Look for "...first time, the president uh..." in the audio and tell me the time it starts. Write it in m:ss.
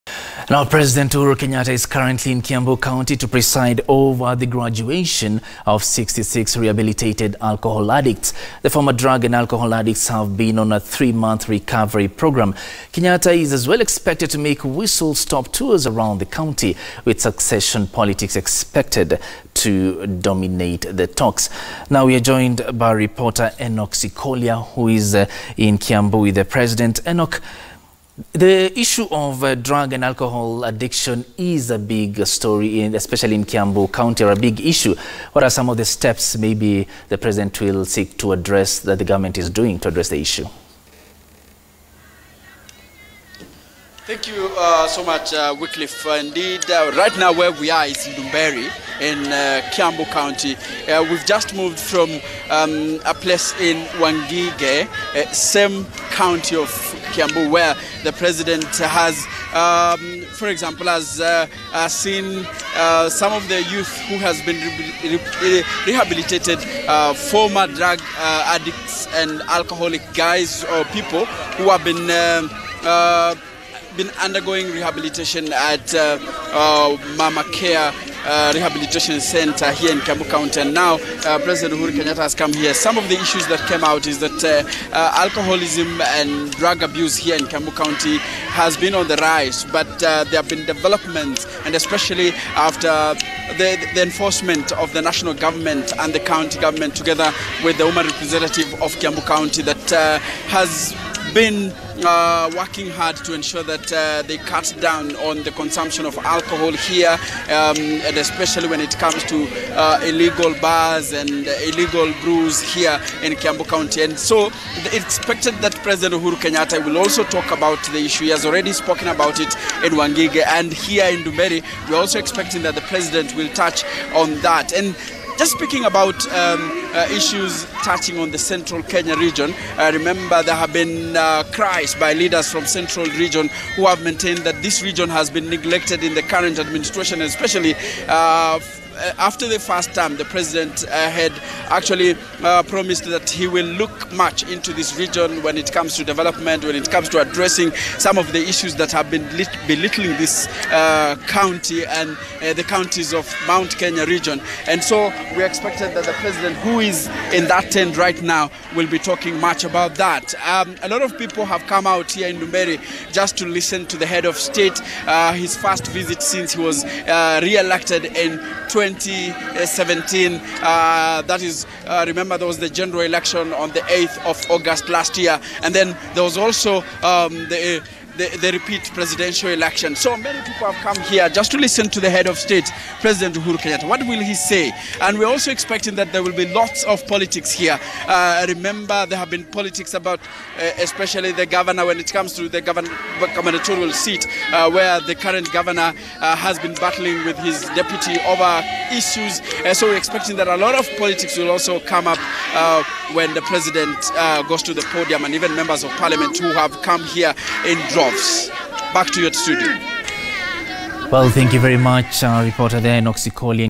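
2:19.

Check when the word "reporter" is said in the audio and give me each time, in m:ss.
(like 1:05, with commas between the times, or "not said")
0:22, 3:32.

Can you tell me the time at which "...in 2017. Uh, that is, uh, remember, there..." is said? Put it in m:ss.
2:48.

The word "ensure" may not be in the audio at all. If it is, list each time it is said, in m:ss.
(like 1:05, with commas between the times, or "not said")
1:43.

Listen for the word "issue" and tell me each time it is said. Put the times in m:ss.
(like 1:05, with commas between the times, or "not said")
0:28, 0:34, 0:40, 1:23, 1:57, 2:07, 2:28, 3:18.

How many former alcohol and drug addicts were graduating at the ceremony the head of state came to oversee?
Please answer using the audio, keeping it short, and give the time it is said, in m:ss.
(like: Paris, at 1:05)
66, at 0:05.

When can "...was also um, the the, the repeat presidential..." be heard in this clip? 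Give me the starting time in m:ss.
2:56.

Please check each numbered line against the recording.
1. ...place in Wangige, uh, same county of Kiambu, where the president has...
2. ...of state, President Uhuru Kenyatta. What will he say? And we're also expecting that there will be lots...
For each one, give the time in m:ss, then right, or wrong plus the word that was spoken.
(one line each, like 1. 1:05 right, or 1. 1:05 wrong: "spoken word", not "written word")
1. 0:53 right
2. 3:02 right.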